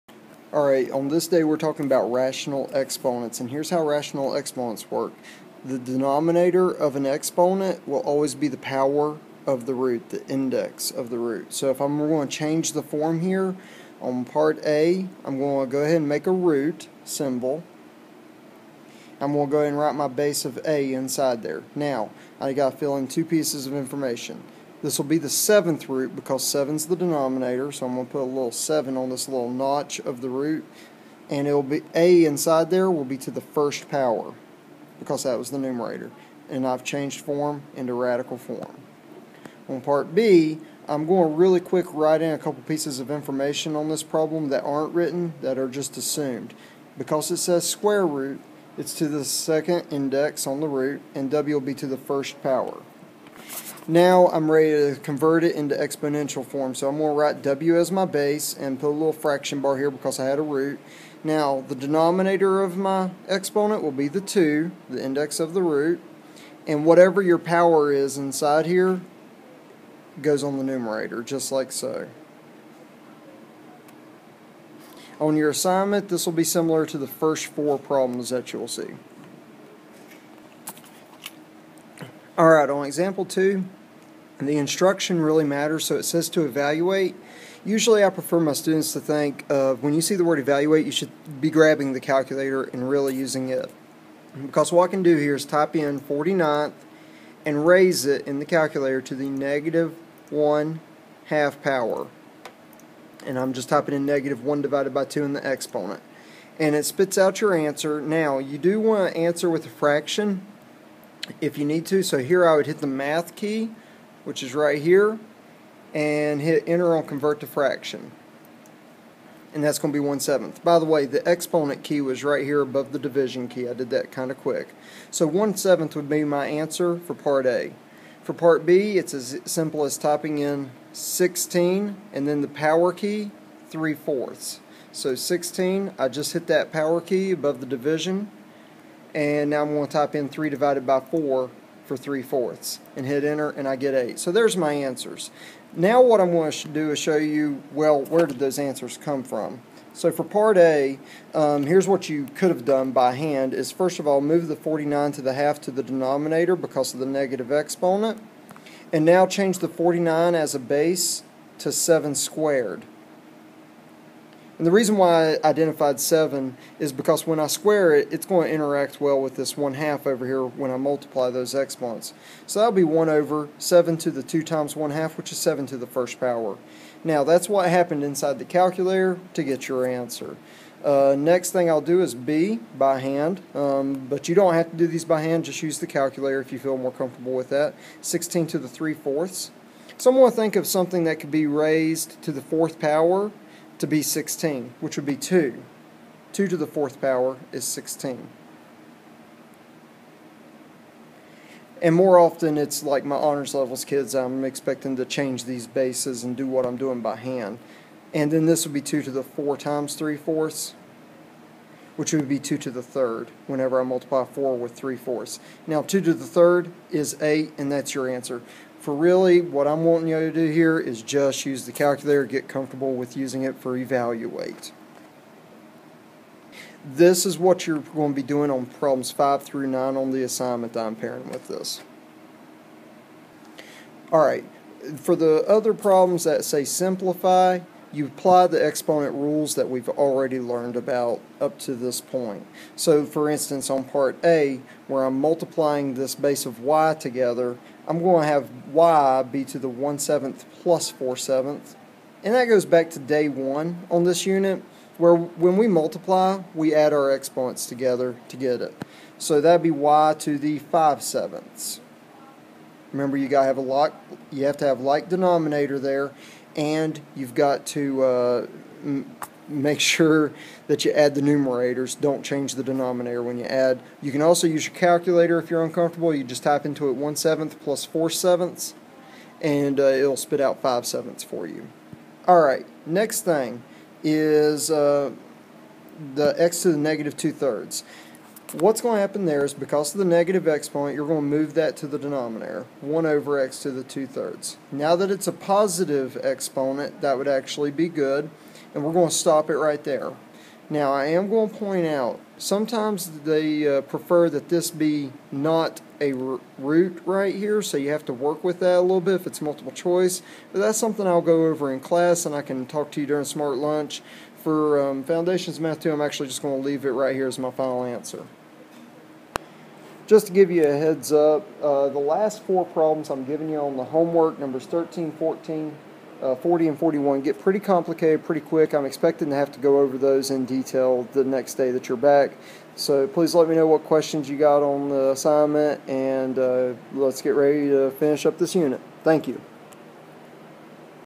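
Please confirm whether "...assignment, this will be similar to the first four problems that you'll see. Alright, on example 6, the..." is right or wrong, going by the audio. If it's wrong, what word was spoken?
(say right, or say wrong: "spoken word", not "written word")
wrong: "2", not "6".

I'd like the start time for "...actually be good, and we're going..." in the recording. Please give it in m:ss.
4:57.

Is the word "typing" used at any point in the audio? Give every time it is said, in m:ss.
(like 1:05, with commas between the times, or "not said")
1:43, 2:09.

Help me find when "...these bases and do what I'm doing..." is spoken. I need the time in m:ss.
3:25.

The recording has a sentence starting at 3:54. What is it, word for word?
Alright, for the other problems that say simplify, you apply the exponent rules that we've already learned about up to this point.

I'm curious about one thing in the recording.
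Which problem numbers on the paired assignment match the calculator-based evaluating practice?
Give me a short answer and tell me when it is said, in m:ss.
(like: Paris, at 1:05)
5 through 9, at 3:48.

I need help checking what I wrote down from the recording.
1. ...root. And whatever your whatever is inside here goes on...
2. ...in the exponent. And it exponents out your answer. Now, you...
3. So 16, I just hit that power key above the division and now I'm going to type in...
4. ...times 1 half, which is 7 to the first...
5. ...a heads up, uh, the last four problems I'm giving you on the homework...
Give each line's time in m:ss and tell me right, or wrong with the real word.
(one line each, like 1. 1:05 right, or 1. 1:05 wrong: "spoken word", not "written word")
1. 1:05 wrong: "power", not "whatever"
2. 1:45 wrong: "spits", not "exponents"
3. 2:14 right
4. 2:54 right
5. 5:20 right.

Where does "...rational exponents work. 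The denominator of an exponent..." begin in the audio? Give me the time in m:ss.
0:03.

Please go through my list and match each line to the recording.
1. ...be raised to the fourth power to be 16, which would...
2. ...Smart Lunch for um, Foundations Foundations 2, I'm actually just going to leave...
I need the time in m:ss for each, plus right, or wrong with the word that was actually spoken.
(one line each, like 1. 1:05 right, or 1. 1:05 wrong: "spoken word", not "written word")
1. 3:11 right
2. 5:13 wrong: "Math", not "Foundations".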